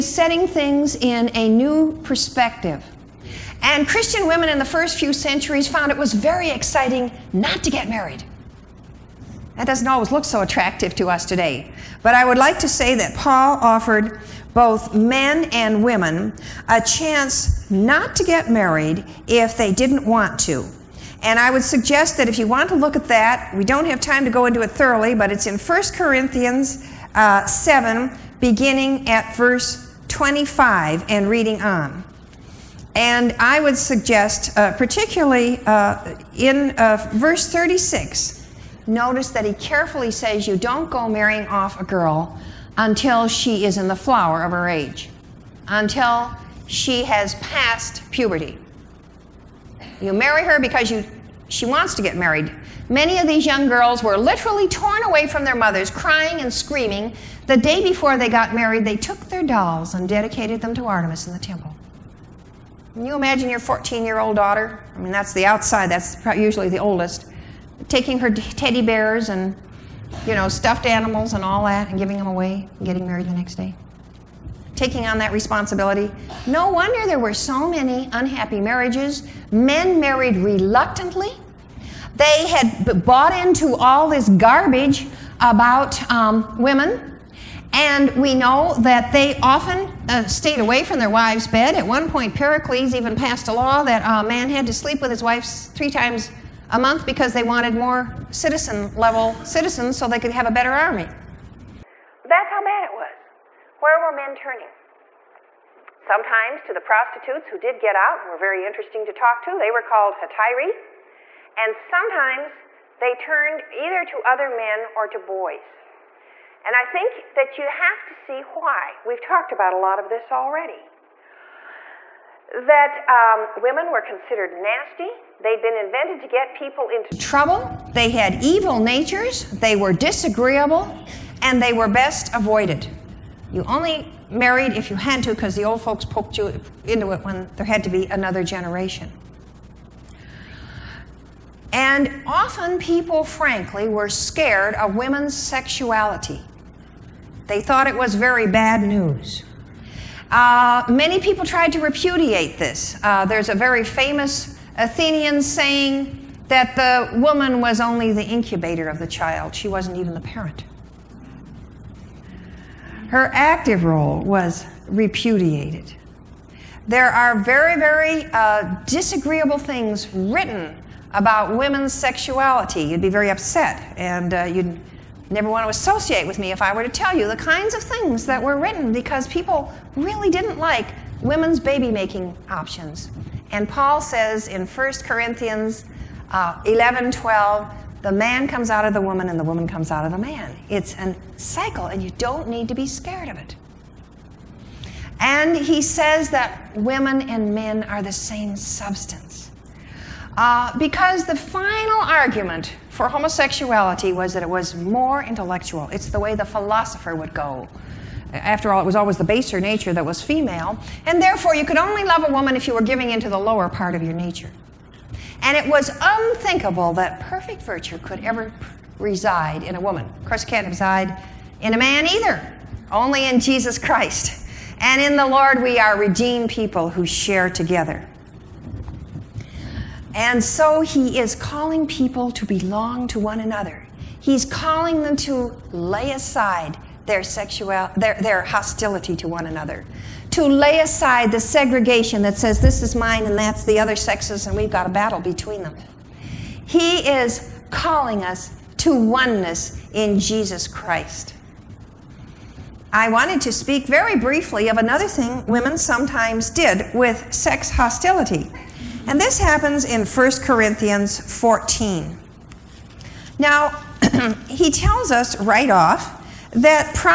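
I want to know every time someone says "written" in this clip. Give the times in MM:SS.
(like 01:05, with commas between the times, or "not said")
02:50, 02:58.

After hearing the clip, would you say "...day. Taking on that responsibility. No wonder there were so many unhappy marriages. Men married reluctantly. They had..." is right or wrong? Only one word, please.
right.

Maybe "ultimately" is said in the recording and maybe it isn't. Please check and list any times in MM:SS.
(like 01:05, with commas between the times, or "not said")
not said.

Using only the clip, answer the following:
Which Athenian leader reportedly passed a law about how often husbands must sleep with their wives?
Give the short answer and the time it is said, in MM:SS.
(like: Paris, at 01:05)
Pericles, at 01:32.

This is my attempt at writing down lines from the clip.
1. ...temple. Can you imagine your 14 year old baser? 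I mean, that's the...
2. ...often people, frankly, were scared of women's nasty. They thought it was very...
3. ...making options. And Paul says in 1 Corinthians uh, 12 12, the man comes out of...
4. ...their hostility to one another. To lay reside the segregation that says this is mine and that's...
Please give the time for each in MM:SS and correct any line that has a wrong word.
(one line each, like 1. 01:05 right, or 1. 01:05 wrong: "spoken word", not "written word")
1. 01:01 wrong: "daughter", not "baser"
2. 02:22 wrong: "sexuality", not "nasty"
3. 03:01 wrong: "11", not "12"
4. 03:58 wrong: "aside", not "reside".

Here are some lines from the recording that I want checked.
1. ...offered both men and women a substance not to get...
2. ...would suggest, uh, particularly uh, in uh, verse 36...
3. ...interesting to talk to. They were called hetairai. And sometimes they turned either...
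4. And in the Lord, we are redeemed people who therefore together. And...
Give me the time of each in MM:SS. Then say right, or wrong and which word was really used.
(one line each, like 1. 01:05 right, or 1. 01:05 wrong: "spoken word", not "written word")
1. 00:13 wrong: "chance", not "substance"
2. 00:33 right
3. 01:48 right
4. 03:44 wrong: "share", not "therefore".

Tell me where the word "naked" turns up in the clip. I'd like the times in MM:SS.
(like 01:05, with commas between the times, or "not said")
not said.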